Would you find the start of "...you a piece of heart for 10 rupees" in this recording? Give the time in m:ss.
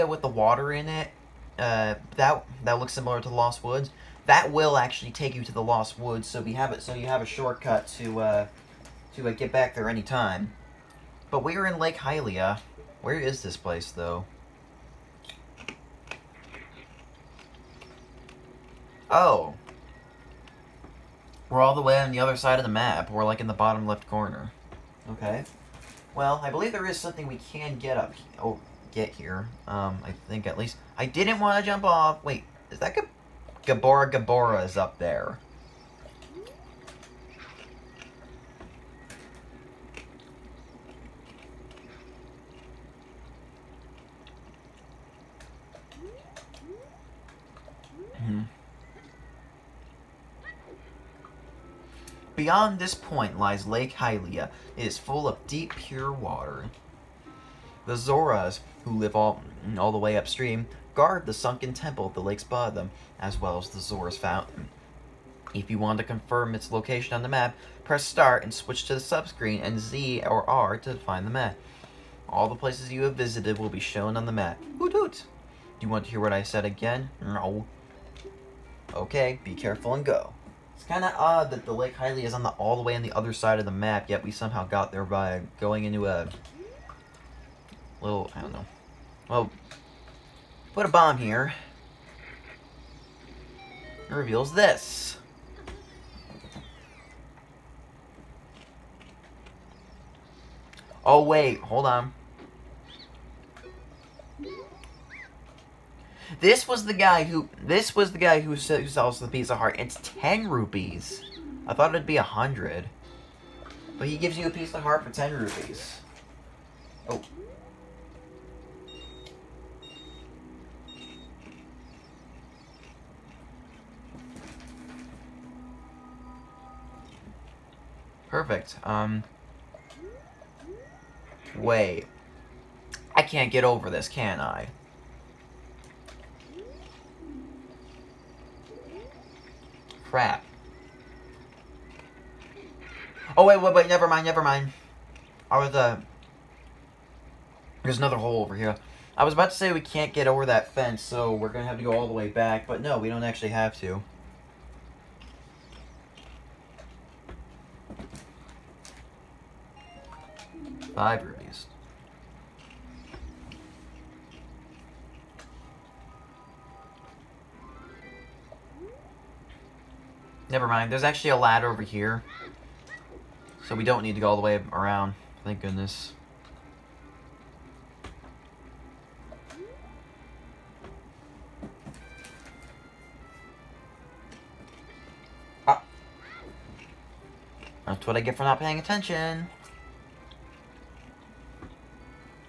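1:54.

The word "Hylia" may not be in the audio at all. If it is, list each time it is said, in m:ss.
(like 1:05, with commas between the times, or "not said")
0:11, 0:53, 1:21.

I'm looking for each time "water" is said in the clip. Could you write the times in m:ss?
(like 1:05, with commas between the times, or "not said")
0:00, 0:56.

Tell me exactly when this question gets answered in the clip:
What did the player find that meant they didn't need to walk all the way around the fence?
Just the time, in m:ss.
2:51.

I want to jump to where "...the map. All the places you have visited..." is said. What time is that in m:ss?
1:11.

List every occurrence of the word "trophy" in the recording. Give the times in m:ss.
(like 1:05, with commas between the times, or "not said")
not said.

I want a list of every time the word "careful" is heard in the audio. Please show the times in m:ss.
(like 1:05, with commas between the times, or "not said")
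1:19.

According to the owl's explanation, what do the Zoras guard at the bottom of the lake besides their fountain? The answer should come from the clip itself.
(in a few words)
The sunken temple.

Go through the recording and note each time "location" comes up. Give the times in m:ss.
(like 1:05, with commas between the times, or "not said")
1:06.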